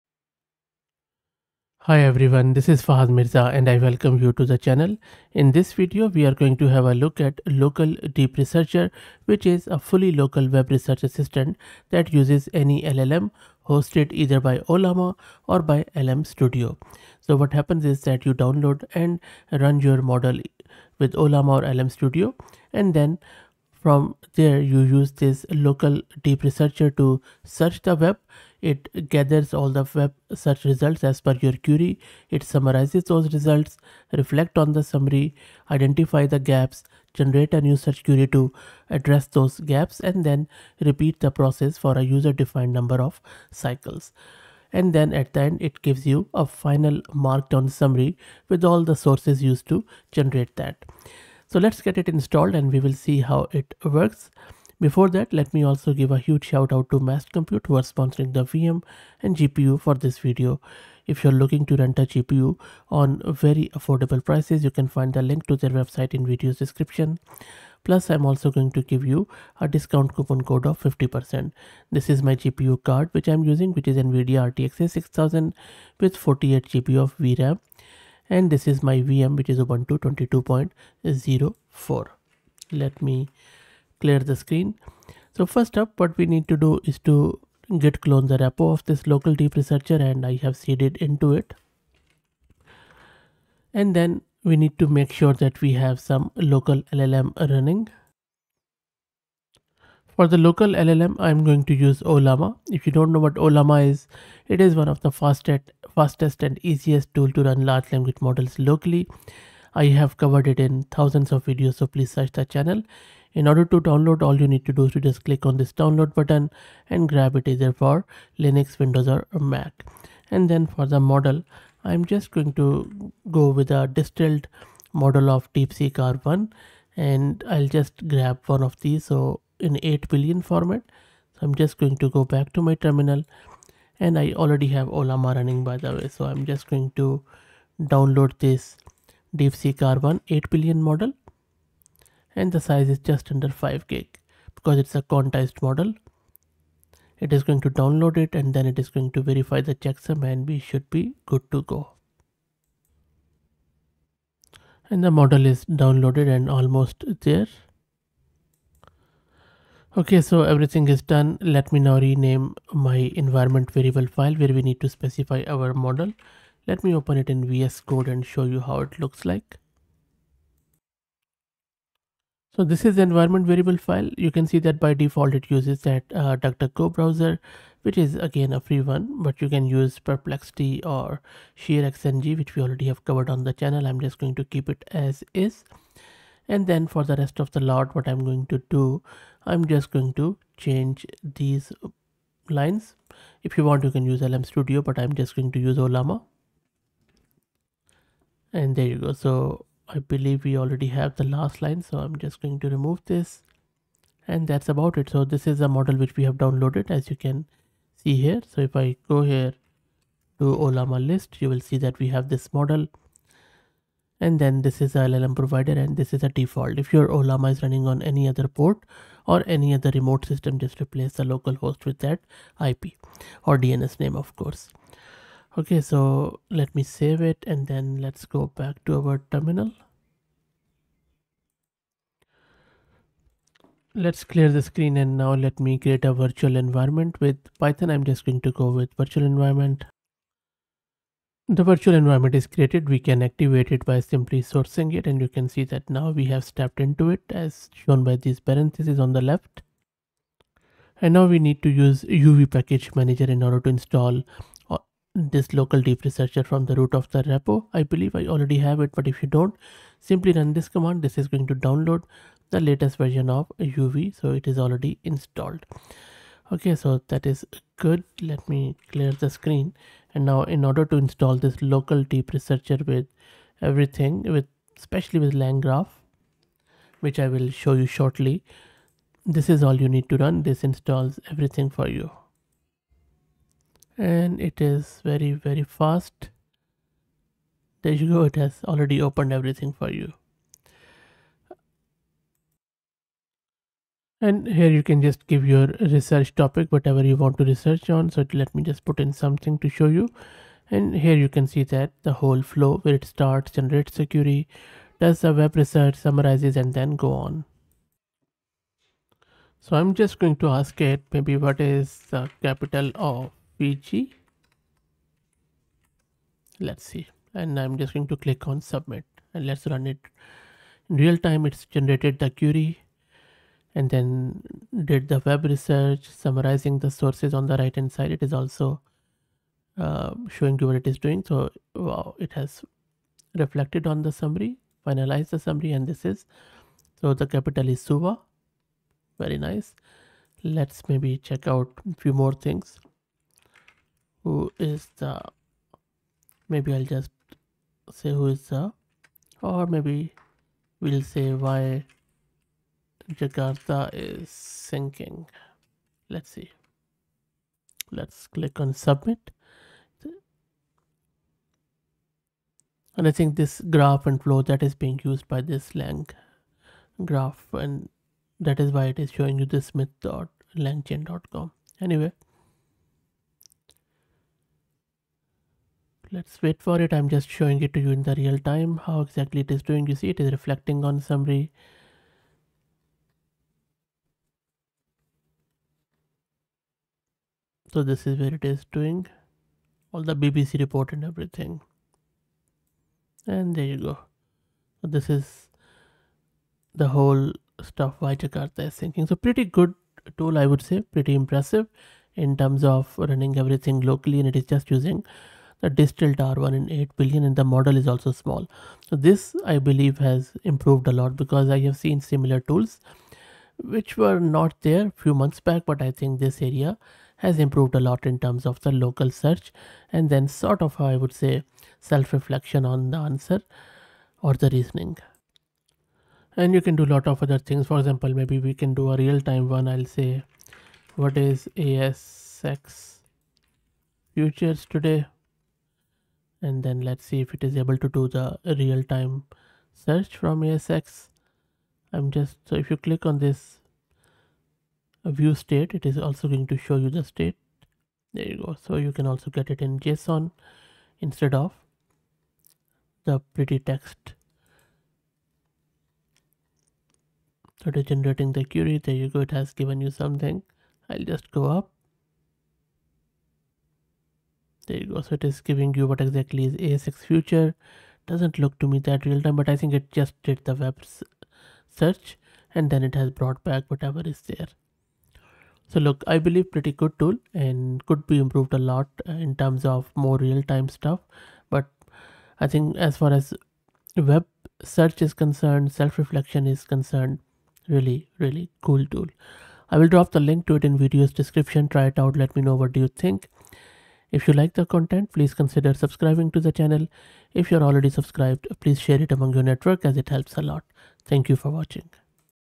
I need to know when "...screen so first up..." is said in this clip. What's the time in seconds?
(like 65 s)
84 s.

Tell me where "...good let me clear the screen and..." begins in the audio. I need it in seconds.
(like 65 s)
267 s.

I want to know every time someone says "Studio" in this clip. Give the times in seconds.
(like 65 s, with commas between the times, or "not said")
16 s, 21 s, 194 s.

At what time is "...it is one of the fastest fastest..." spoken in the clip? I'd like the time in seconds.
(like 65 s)
104 s.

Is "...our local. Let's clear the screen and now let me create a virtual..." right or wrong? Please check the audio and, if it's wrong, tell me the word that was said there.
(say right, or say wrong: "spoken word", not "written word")
wrong: "terminal", not "local".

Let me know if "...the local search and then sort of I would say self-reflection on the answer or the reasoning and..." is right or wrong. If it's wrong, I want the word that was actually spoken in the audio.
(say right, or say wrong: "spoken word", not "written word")
right.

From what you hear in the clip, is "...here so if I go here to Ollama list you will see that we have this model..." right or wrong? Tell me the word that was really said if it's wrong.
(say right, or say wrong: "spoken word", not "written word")
right.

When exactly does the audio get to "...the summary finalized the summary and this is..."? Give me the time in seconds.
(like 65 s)
334 s.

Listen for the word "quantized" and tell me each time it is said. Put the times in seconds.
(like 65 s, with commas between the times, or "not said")
145 s.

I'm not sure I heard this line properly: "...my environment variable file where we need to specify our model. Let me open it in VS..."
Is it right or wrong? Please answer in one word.
right.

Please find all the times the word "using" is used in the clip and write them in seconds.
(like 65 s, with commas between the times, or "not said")
73 s, 404 s.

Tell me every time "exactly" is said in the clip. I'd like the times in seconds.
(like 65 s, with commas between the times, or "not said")
379 s, 465 s.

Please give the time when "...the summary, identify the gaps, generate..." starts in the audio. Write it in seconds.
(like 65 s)
34 s.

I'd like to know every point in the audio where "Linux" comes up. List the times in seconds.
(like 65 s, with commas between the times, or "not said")
118 s.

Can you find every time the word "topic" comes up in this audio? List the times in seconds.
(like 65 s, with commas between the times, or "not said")
296 s.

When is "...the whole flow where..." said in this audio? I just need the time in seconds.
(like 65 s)
302 s.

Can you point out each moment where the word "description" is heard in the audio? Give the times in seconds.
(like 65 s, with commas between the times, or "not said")
66 s, 491 s.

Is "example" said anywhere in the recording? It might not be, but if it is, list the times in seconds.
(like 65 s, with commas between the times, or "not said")
427 s.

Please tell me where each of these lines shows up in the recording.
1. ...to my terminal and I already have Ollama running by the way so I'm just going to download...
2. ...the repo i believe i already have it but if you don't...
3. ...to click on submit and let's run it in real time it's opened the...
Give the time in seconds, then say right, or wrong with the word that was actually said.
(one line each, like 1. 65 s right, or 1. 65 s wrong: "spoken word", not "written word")
1. 132 s right
2. 257 s right
3. 318 s wrong: "generated", not "opened".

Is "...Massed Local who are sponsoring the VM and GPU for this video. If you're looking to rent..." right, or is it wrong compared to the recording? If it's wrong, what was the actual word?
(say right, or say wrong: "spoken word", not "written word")
wrong: "Compute", not "Local".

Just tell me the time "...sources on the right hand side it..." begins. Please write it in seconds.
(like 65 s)
326 s.